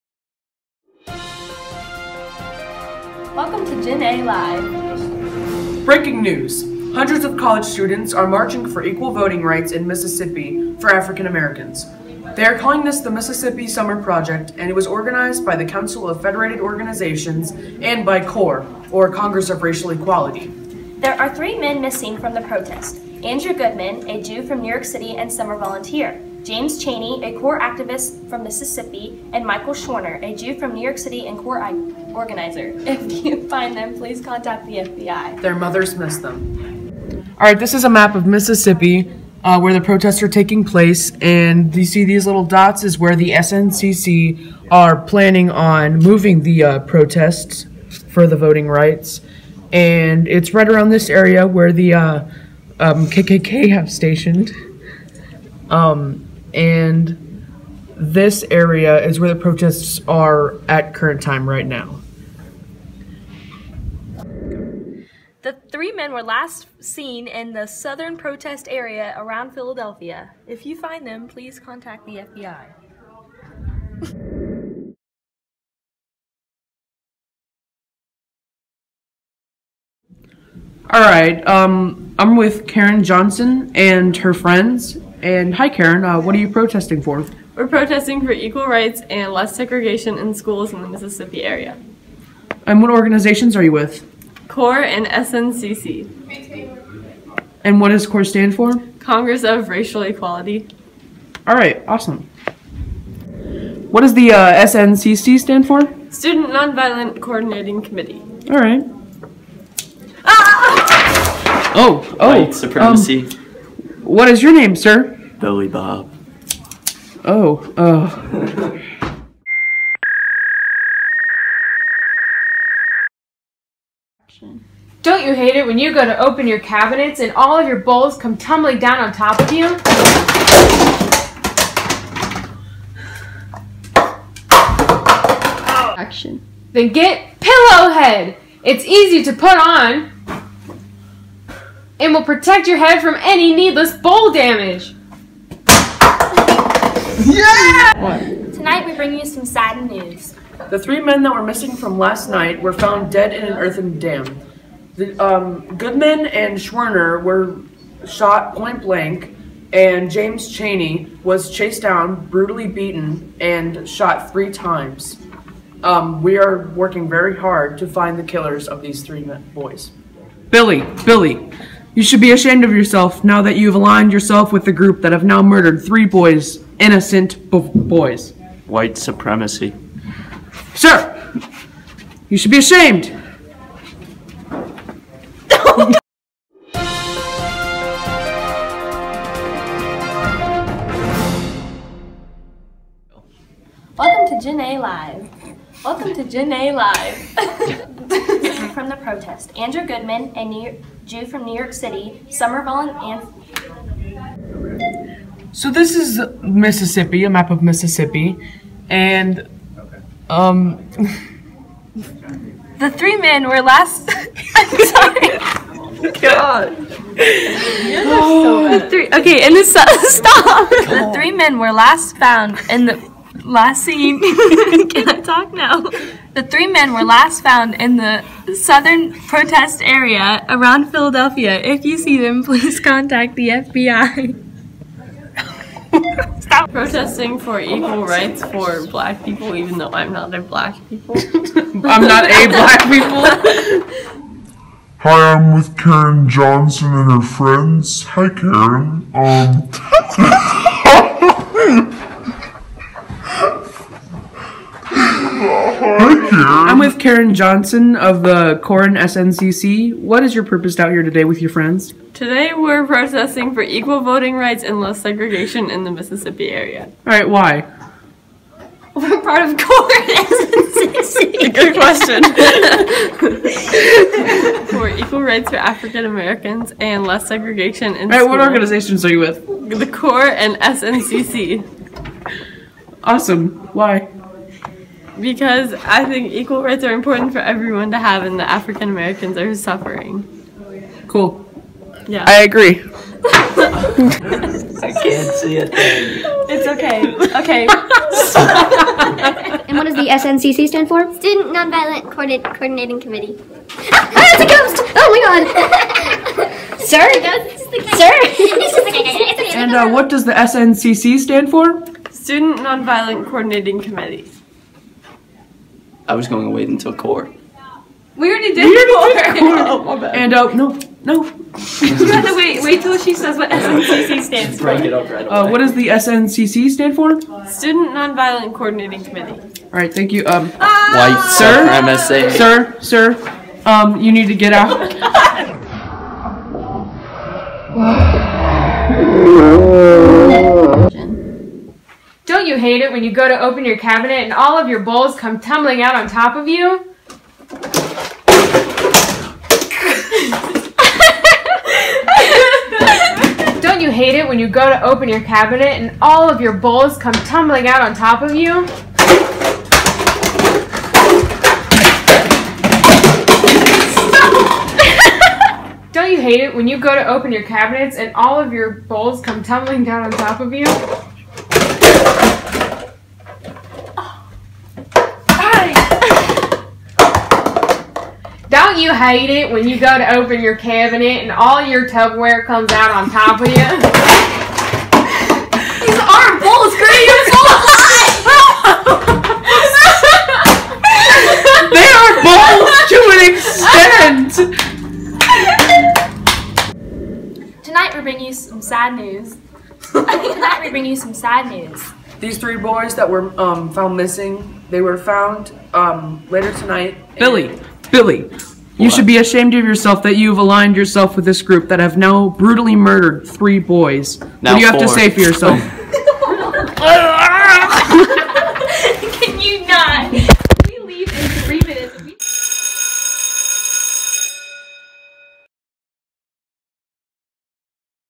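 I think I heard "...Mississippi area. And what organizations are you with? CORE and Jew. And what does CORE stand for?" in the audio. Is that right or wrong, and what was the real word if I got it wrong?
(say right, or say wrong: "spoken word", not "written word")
wrong: "SNCC", not "Jew".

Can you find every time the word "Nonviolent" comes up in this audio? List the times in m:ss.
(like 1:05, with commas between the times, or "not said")
1:46, 5:01, 5:12, 5:27.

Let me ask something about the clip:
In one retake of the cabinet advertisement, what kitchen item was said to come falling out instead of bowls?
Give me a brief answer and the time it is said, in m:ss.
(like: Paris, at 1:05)
Tupperware, at 6:21.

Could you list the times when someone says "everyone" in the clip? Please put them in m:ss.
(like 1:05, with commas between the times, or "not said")
4:47.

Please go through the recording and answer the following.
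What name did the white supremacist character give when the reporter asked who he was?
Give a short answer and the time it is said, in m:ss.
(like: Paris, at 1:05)
Billy Bob, at 1:55.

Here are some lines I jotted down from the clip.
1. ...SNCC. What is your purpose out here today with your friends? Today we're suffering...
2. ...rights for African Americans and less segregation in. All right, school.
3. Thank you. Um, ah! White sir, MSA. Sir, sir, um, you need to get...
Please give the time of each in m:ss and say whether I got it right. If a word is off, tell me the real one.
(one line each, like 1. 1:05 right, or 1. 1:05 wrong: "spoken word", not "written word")
1. 4:18 wrong: "protesting", not "suffering"
2. 4:35 right
3. 5:29 right.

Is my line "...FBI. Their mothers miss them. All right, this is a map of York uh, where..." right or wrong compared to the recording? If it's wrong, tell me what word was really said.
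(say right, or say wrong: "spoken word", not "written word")
wrong: "Mississippi", not "York".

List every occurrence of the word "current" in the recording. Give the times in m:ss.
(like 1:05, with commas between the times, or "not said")
1:00.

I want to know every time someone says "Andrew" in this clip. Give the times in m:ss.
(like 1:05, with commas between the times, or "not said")
0:23, 3:19.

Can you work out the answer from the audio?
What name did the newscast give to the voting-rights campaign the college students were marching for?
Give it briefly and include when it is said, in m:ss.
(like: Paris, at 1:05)
Mississippi Summer Project, at 0:13.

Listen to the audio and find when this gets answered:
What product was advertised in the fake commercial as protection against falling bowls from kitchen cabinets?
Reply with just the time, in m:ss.
2:17.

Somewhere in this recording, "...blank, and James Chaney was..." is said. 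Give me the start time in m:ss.
2:38.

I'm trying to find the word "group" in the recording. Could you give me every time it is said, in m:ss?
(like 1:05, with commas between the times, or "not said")
2:54, 6:51.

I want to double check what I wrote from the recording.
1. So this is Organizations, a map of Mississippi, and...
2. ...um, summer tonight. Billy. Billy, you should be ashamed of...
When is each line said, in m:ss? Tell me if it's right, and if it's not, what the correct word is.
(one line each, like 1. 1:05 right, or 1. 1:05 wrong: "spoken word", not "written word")
1. 3:25 wrong: "Mississippi", not "Organizations"
2. 6:45 wrong: "later", not "summer".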